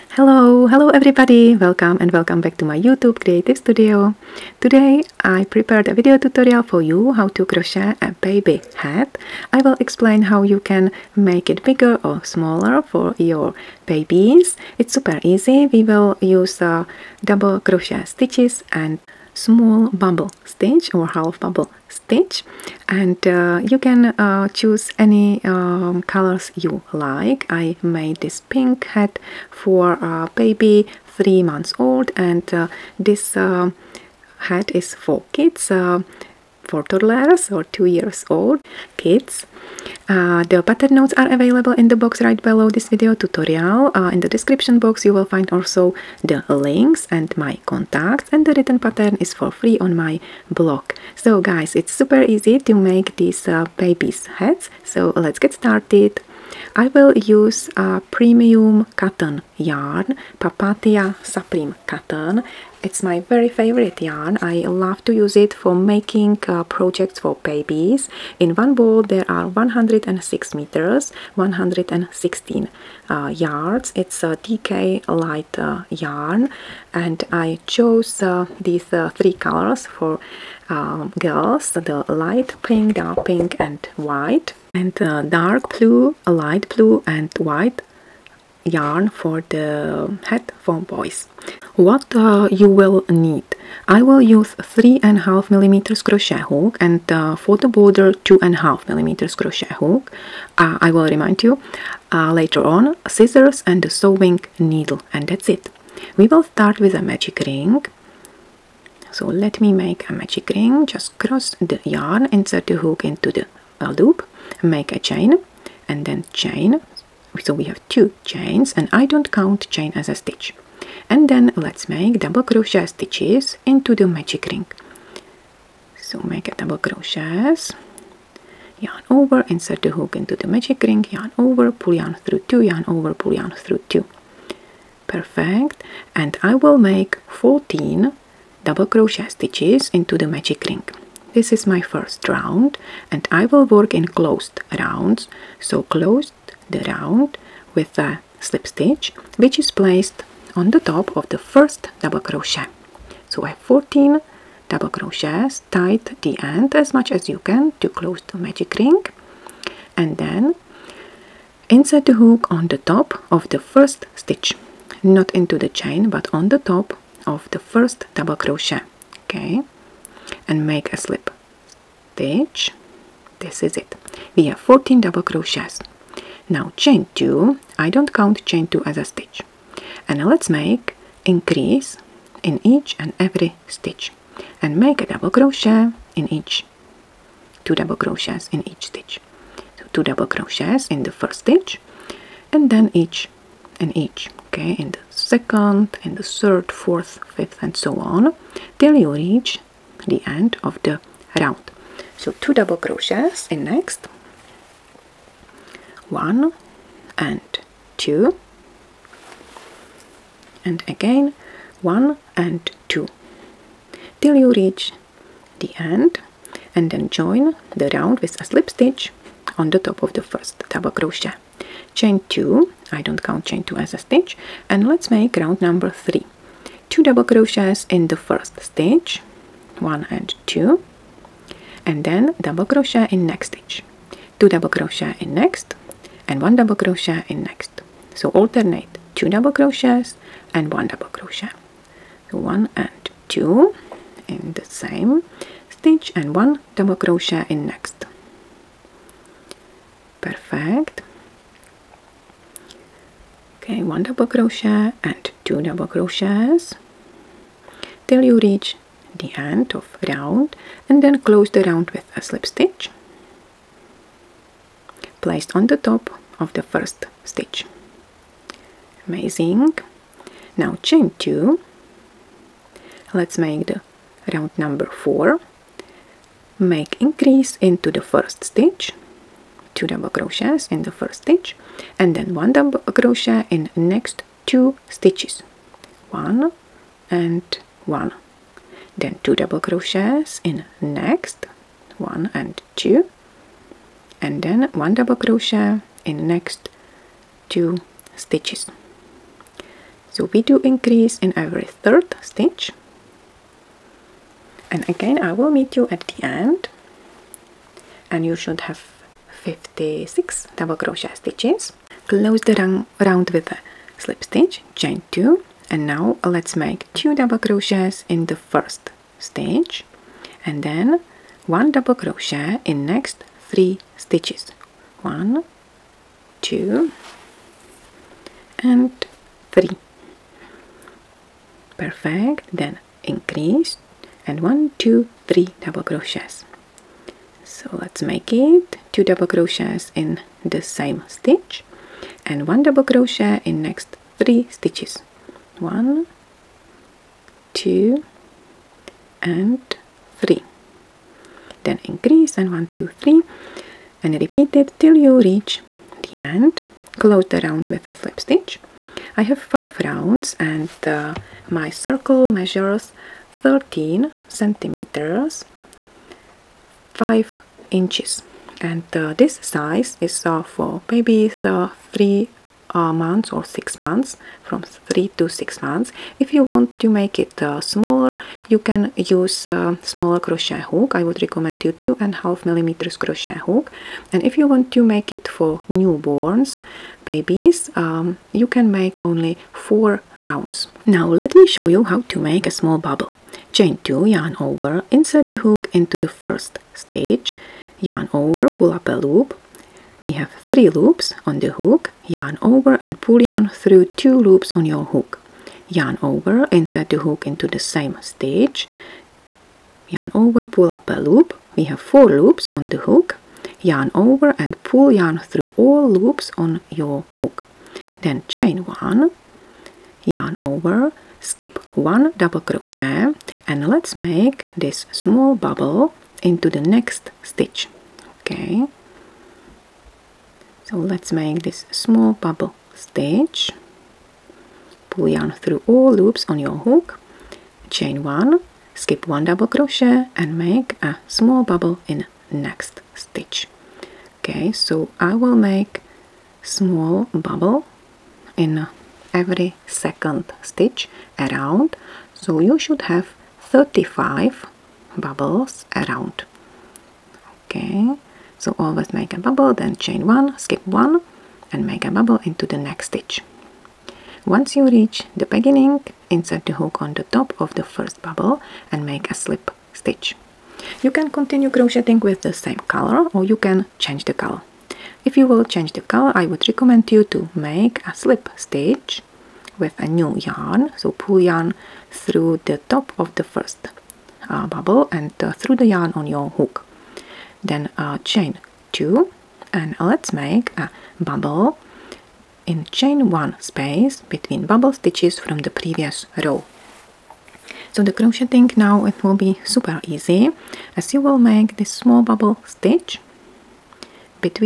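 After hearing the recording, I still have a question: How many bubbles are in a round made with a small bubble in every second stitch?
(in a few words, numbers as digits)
35.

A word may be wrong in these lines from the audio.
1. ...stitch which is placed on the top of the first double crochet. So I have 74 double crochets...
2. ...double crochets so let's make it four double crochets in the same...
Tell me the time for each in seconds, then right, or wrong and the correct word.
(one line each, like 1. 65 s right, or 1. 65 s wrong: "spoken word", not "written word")
1. 148 s wrong: "14", not "74"
2. 335 s wrong: "two", not "four".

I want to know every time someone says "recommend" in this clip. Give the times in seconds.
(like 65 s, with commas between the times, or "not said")
381 s, 476 s.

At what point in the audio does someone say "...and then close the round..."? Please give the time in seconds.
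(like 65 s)
260 s.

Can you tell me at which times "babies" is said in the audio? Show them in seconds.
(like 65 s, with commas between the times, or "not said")
13 s, 67 s, 370 s, 387 s.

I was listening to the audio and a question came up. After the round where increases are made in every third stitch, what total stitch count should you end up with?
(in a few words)
56.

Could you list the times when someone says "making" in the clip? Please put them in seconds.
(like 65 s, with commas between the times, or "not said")
65 s.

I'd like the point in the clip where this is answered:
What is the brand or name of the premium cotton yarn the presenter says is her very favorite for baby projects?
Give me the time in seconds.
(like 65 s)
60 s.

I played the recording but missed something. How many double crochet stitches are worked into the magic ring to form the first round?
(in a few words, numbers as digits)
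14.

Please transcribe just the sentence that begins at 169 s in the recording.
Okay, and make a slip stitch.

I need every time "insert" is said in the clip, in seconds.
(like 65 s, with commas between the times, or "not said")
112 s, 129 s, 161 s, 394 s, 406 s, 466 s.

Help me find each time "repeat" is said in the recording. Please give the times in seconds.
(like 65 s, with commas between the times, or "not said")
354 s.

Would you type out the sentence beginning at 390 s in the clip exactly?
Now let me show you how to make a small bubble.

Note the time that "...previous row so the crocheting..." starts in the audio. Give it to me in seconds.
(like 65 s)
495 s.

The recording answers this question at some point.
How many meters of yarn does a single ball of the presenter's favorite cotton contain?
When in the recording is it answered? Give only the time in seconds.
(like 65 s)
69 s.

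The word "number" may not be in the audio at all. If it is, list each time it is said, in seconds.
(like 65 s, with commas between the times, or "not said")
225 s, 274 s.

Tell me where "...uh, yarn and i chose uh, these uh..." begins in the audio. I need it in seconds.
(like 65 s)
75 s.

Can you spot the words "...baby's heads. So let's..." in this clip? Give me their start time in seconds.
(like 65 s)
53 s.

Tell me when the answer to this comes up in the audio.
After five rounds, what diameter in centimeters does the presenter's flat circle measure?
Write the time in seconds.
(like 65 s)
363 s.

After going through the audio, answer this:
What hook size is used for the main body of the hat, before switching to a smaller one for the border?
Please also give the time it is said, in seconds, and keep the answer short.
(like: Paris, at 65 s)
3.5 millimeters, at 94 s.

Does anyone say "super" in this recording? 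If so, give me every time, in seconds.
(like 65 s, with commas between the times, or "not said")
14 s, 51 s, 499 s.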